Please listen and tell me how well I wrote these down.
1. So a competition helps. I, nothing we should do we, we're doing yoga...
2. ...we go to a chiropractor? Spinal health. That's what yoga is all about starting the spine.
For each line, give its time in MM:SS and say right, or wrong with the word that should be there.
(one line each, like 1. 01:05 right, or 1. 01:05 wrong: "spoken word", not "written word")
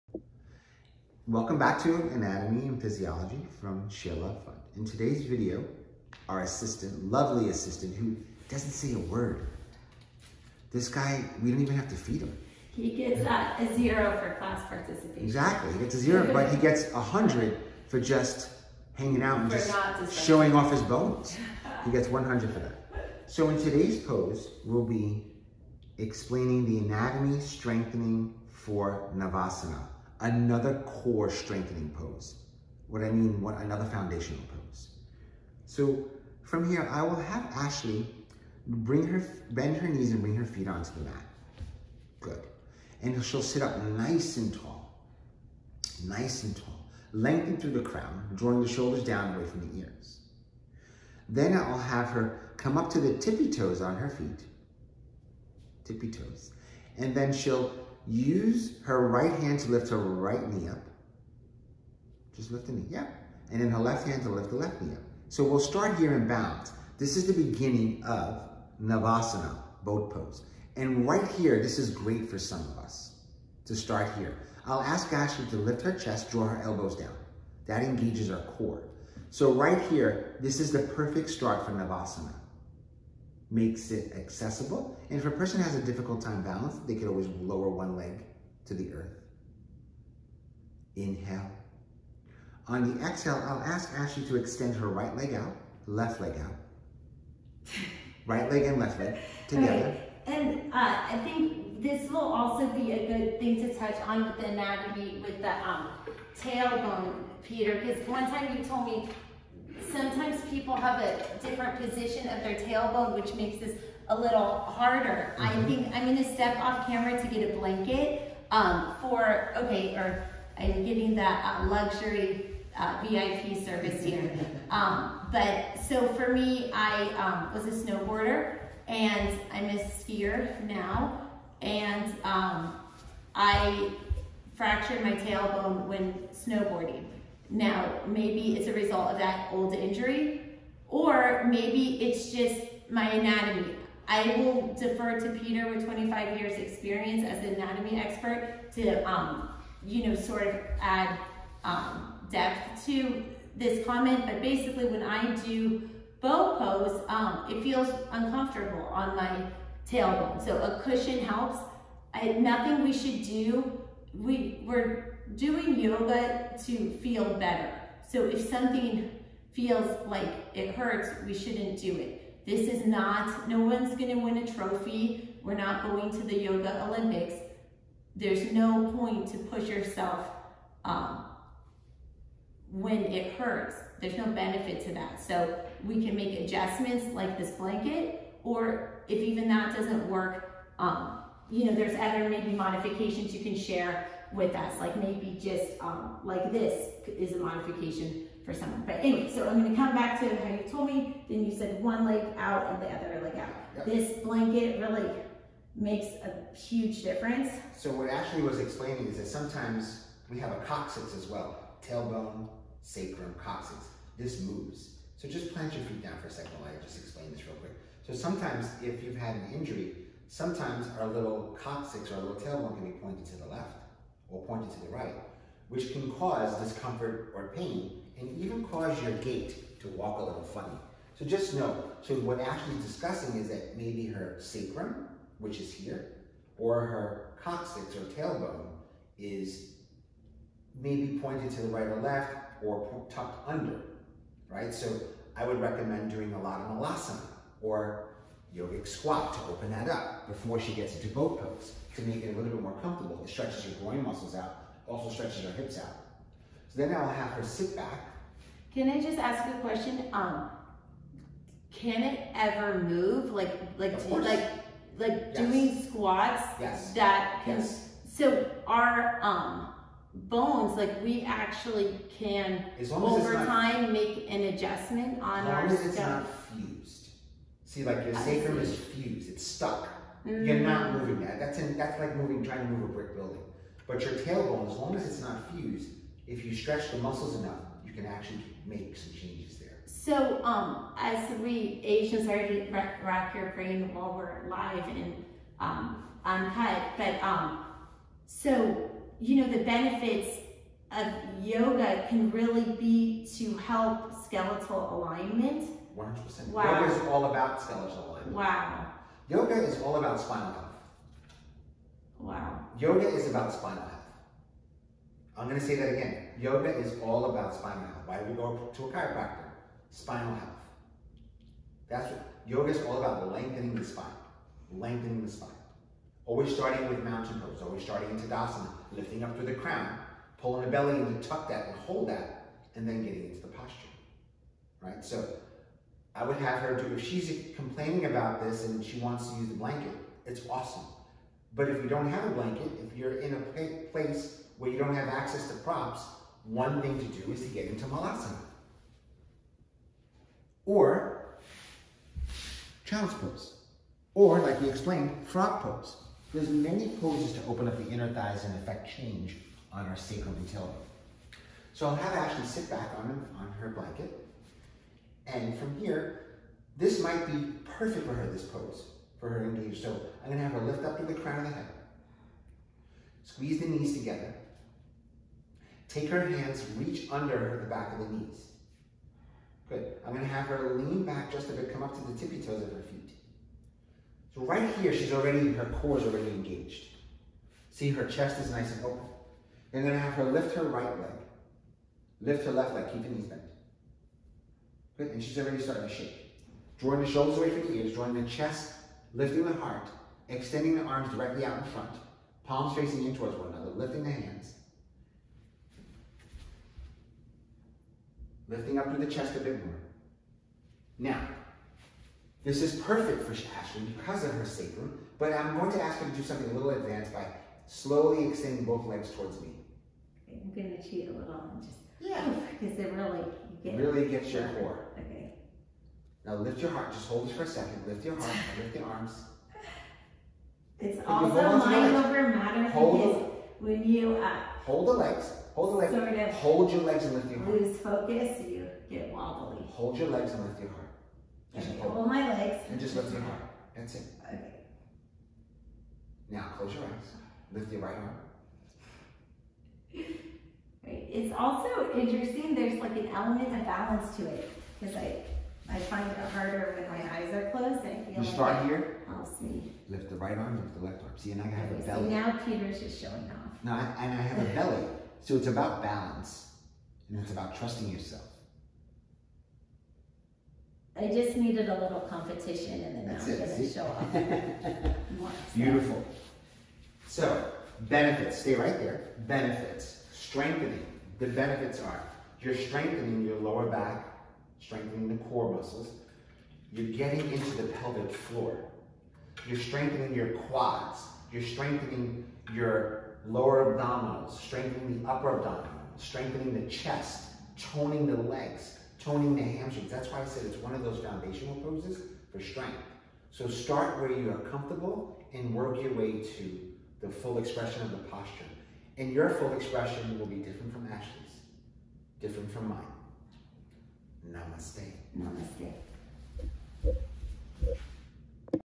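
1. 02:40 wrong: "cushion", not "competition"
2. 05:18 wrong: "lengthening", not "starting".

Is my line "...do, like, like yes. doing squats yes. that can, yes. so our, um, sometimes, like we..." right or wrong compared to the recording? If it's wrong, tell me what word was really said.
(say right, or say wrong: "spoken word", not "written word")
wrong: "bones", not "sometimes".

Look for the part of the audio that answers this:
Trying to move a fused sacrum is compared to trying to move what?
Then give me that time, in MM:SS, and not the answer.
04:42.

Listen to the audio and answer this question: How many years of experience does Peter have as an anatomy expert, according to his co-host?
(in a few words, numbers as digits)
25 years.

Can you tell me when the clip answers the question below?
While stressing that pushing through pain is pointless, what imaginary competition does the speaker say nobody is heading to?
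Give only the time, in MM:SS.
02:56.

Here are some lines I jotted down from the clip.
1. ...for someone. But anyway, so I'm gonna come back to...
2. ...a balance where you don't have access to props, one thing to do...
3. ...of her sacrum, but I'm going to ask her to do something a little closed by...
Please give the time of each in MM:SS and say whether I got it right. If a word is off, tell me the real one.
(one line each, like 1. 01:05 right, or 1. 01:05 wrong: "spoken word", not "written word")
1. 03:18 right
2. 05:43 wrong: "place", not "balance"
3. 06:54 wrong: "advanced", not "closed".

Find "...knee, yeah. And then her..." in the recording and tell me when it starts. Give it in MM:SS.
01:02.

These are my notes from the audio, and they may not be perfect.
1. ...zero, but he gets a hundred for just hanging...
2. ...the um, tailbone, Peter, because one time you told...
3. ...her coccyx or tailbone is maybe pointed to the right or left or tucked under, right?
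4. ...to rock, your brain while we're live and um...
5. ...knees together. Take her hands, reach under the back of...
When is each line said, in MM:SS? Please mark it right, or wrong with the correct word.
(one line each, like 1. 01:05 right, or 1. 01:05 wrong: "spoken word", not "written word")
1. 00:15 right
2. 01:45 right
3. 03:56 right
4. 04:52 right
5. 06:13 right.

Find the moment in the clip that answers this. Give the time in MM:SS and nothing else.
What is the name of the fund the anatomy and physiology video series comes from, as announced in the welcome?
00:03.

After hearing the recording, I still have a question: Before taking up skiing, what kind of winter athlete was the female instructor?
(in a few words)
Snowboarder.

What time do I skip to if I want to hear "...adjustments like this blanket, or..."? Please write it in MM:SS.
03:06.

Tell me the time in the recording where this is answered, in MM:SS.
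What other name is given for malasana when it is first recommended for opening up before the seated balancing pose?
04:08.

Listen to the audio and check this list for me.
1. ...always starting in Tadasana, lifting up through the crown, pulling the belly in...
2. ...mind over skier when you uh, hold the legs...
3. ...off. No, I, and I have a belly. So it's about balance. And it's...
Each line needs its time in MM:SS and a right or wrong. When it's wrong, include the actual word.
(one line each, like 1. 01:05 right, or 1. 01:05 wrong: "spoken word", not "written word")
1. 05:27 right
2. 07:11 wrong: "matter", not "skier"
3. 07:43 right.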